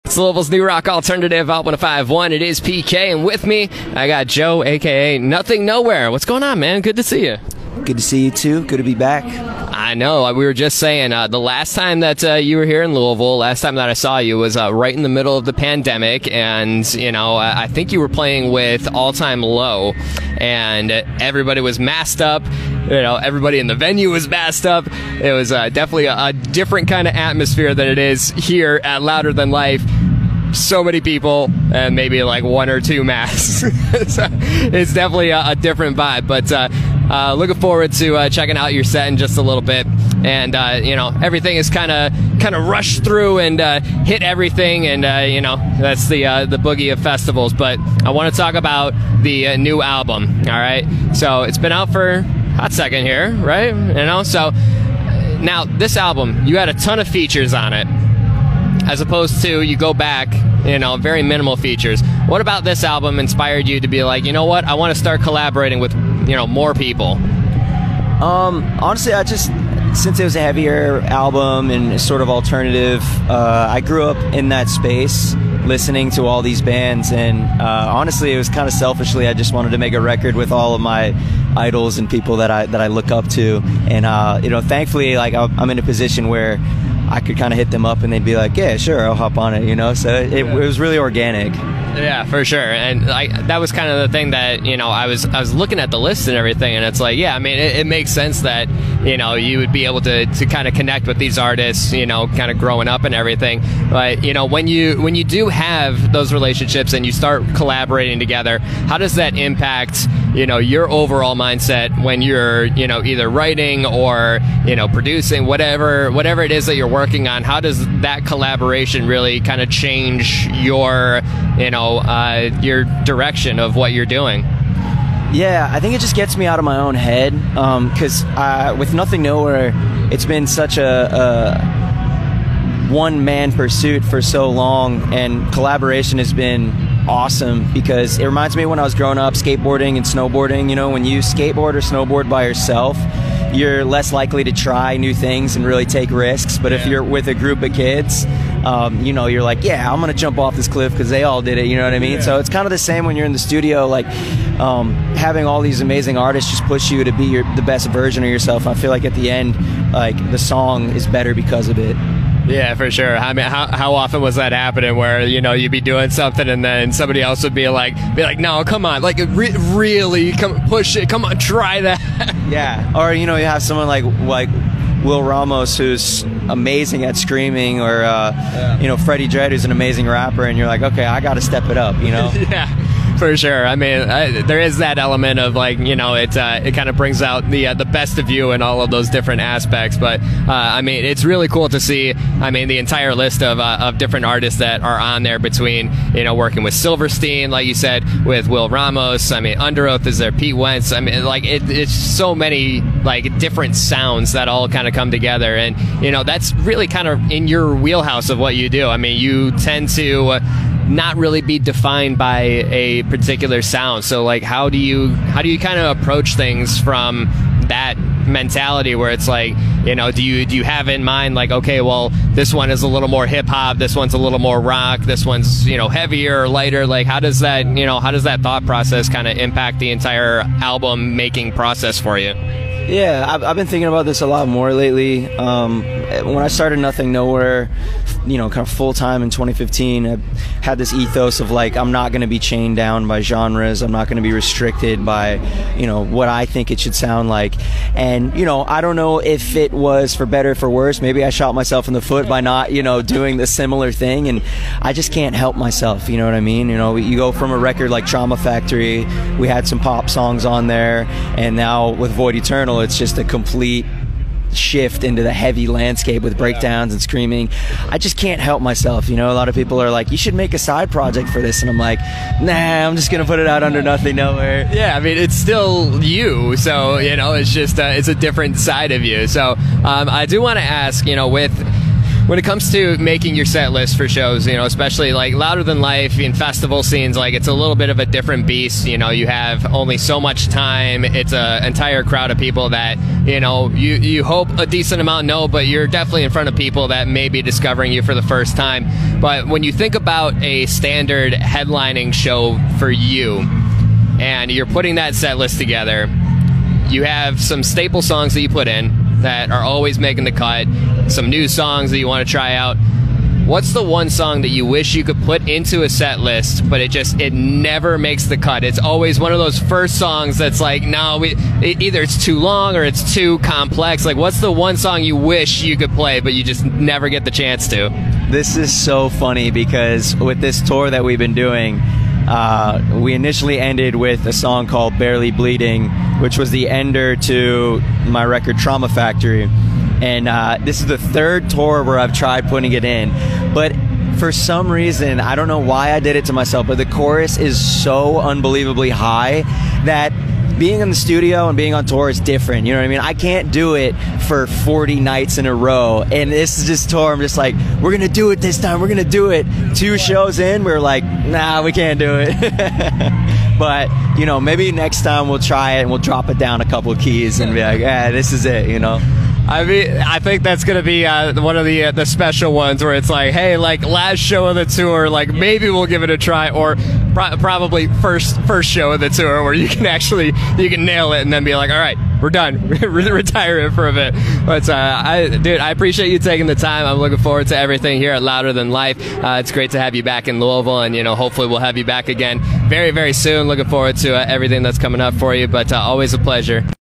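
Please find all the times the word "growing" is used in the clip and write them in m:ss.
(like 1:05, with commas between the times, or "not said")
1:42, 2:18.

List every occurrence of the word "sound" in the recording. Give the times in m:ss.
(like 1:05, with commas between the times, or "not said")
3:23, 3:33, 4:06.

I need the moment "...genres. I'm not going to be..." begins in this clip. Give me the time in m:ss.
4:03.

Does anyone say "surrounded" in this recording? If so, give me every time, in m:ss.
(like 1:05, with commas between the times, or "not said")
not said.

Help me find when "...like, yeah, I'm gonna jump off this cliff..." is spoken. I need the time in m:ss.
2:29.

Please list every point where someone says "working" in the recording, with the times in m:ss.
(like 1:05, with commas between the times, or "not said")
1:56, 3:16.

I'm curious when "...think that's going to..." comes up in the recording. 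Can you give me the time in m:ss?
6:10.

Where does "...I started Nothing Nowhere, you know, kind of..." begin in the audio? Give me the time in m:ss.
3:56.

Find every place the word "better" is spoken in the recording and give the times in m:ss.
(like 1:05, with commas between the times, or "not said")
2:41, 4:10.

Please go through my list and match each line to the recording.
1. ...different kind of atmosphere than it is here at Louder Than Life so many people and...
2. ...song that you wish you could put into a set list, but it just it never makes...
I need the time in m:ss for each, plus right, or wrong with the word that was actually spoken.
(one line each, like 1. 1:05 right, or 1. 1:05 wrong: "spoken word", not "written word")
1. 0:26 right
2. 5:14 right.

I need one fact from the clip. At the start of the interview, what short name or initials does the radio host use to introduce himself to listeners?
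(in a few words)
PK.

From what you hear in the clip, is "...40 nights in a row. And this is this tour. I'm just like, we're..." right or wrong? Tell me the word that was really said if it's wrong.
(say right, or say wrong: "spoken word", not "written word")
right.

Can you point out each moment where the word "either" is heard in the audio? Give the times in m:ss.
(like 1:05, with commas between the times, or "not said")
1:53, 5:21.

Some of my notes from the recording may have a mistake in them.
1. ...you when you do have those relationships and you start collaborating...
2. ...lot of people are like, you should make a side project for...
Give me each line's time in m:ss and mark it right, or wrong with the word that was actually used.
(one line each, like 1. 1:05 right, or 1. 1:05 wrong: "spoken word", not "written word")
1. 1:44 right
2. 4:29 right.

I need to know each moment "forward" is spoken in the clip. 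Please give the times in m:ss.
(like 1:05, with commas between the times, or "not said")
0:37, 6:27, 6:33.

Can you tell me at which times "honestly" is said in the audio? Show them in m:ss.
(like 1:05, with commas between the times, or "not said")
1:08, 1:17.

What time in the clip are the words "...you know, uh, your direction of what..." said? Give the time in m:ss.
2:01.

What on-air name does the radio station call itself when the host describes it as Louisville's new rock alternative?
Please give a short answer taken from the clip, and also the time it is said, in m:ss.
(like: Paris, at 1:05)
Alt 1051, at 0:01.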